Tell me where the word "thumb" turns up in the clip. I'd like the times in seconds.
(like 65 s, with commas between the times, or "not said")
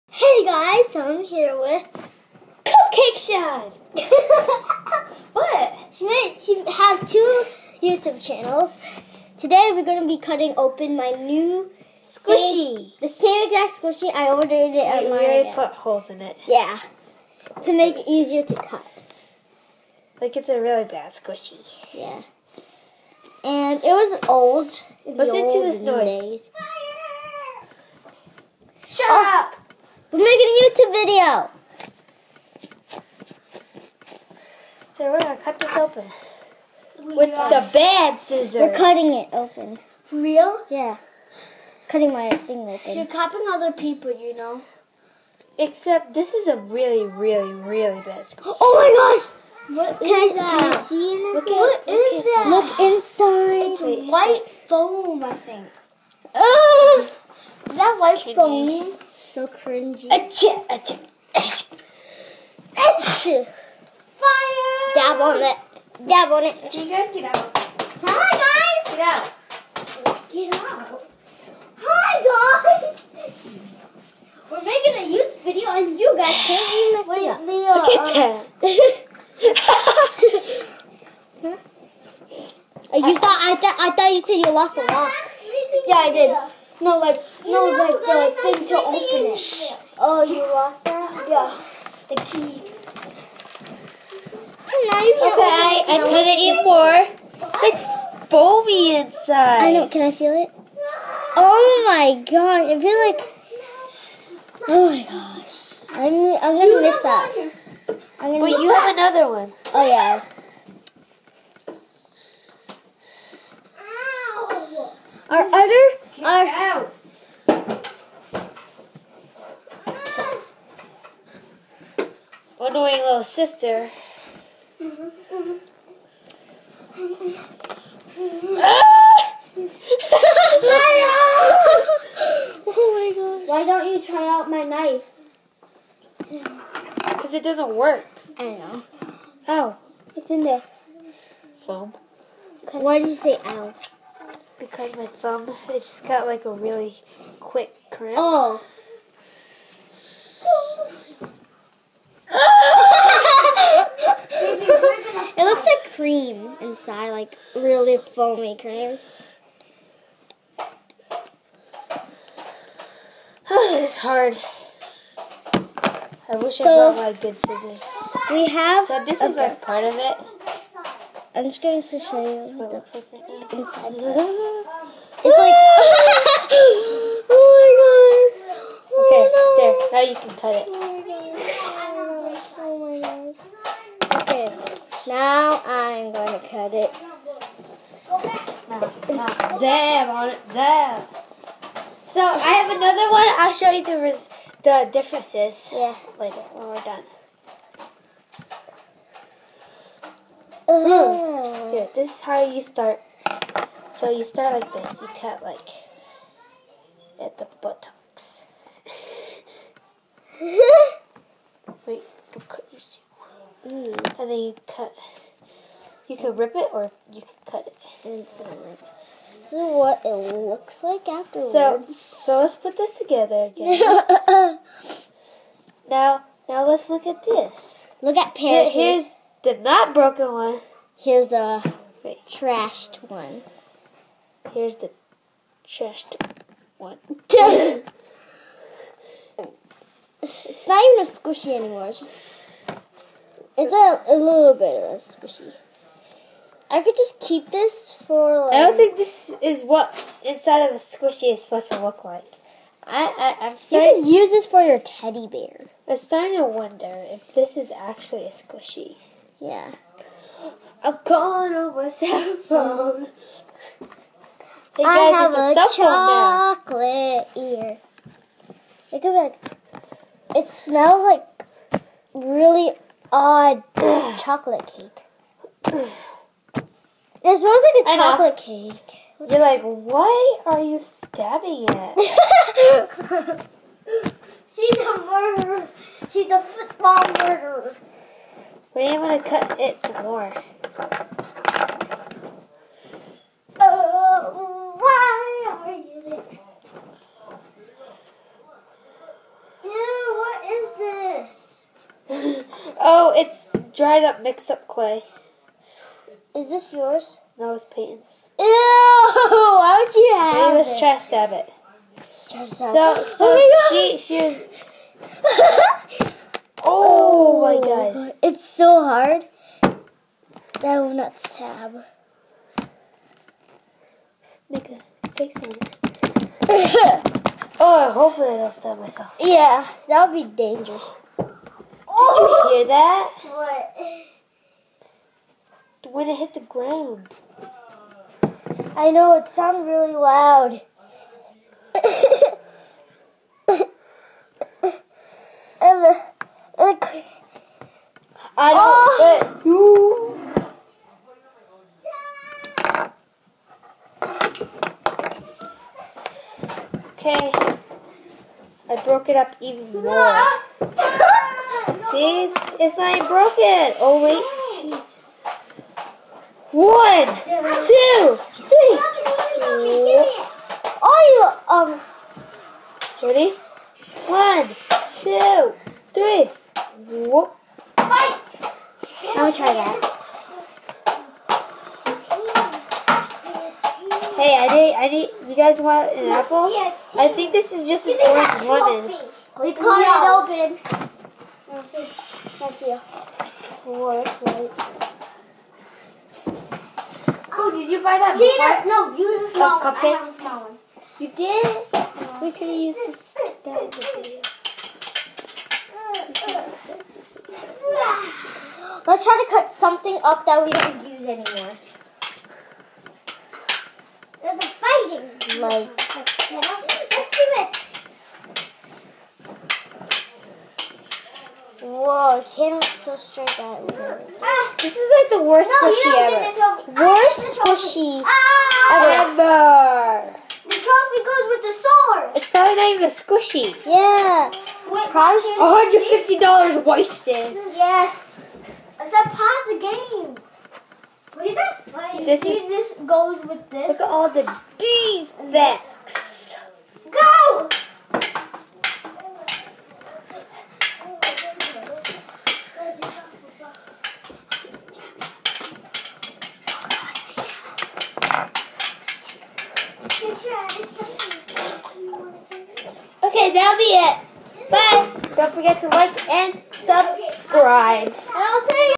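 145 s.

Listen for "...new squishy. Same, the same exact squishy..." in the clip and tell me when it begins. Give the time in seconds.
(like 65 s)
11 s.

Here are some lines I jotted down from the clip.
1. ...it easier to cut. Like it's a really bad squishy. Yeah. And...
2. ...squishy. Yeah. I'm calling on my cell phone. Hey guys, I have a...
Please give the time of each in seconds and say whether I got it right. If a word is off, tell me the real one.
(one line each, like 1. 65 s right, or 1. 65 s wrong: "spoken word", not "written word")
1. 17 s right
2. 258 s right.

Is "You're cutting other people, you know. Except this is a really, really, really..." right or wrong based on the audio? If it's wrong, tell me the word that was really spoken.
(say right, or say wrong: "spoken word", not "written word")
wrong: "copying", not "cutting".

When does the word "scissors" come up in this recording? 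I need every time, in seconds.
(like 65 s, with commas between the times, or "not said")
38 s, 167 s.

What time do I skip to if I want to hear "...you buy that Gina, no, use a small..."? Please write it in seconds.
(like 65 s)
397 s.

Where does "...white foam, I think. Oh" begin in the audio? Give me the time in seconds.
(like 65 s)
54 s.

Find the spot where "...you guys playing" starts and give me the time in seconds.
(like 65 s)
441 s.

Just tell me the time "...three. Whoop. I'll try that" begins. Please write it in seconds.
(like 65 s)
375 s.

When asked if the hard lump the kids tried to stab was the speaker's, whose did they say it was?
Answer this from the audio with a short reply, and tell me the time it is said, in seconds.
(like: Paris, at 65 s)
Peyton's, at 307 s.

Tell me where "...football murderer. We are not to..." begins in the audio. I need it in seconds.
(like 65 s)
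286 s.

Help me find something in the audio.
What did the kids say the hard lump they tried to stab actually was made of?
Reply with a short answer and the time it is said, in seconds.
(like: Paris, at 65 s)
Dried up, mixed up clay, at 303 s.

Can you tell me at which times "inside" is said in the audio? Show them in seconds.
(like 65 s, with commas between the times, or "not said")
52 s, 98 s, 156 s, 173 s, 250 s.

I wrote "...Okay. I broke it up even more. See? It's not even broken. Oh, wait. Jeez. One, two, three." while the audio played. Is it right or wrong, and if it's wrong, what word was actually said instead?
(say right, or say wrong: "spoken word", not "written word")
right.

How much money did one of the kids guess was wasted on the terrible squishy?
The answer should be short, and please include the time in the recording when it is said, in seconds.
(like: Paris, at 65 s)
$150, at 435 s.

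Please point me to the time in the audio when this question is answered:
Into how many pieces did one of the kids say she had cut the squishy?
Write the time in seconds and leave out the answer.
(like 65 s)
96 s.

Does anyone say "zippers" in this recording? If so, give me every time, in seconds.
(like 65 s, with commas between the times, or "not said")
not said.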